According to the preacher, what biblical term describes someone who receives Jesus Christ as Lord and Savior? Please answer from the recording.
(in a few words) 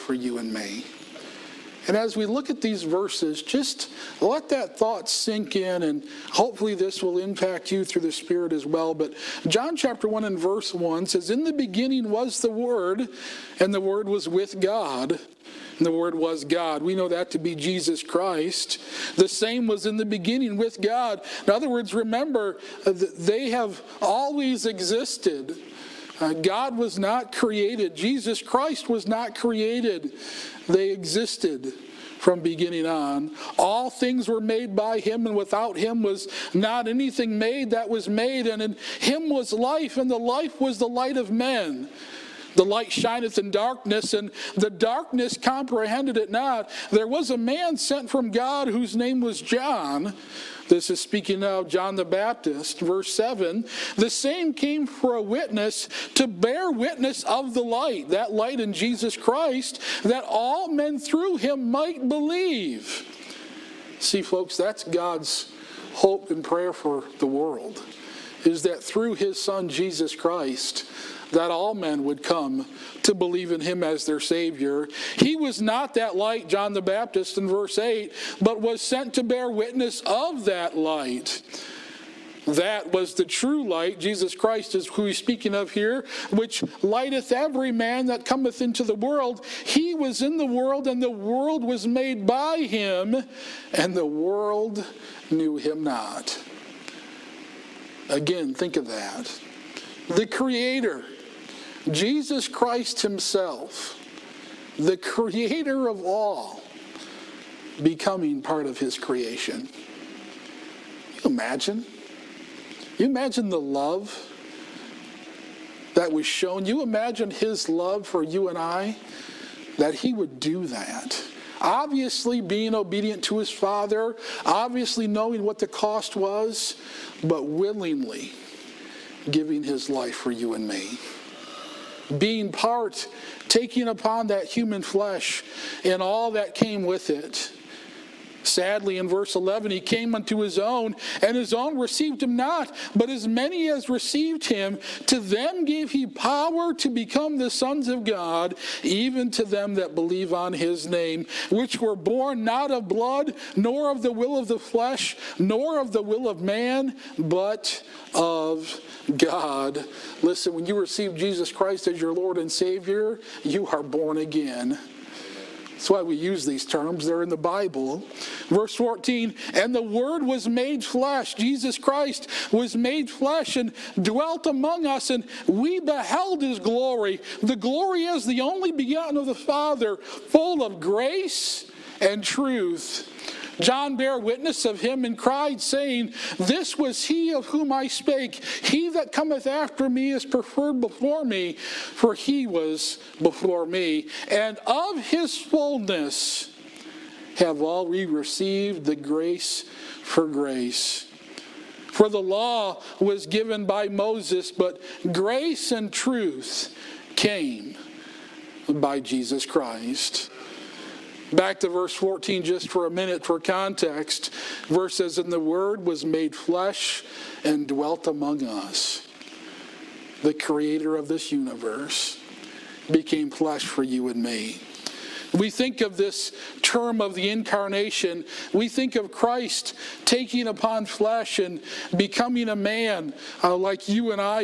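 born again.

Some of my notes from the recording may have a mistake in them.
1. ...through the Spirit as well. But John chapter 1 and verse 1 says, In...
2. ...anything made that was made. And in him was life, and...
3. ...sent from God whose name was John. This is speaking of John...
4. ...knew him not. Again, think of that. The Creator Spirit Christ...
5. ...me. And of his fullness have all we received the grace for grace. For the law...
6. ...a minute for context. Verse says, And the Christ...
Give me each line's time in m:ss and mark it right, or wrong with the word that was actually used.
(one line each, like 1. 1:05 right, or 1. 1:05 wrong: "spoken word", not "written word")
1. 0:07 right
2. 0:36 right
3. 0:47 right
4. 1:35 wrong: "Jesus", not "Spirit"
5. 3:13 right
6. 3:32 wrong: "Word", not "Christ".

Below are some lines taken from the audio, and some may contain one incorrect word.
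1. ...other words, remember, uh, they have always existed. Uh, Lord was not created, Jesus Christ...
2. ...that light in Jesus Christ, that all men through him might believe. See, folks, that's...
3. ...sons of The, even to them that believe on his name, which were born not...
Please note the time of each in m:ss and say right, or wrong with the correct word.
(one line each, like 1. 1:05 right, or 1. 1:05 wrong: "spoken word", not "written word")
1. 0:21 wrong: "God", not "Lord"
2. 0:58 right
3. 2:27 wrong: "God", not "The".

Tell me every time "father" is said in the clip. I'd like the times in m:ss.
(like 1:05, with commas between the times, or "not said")
2:03, 2:59.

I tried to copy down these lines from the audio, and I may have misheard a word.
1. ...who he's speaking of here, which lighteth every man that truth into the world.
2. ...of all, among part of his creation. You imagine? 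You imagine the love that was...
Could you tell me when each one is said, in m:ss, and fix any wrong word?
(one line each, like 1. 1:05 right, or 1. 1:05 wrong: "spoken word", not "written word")
1. 1:24 wrong: "cometh", not "truth"
2. 1:45 wrong: "becoming", not "among".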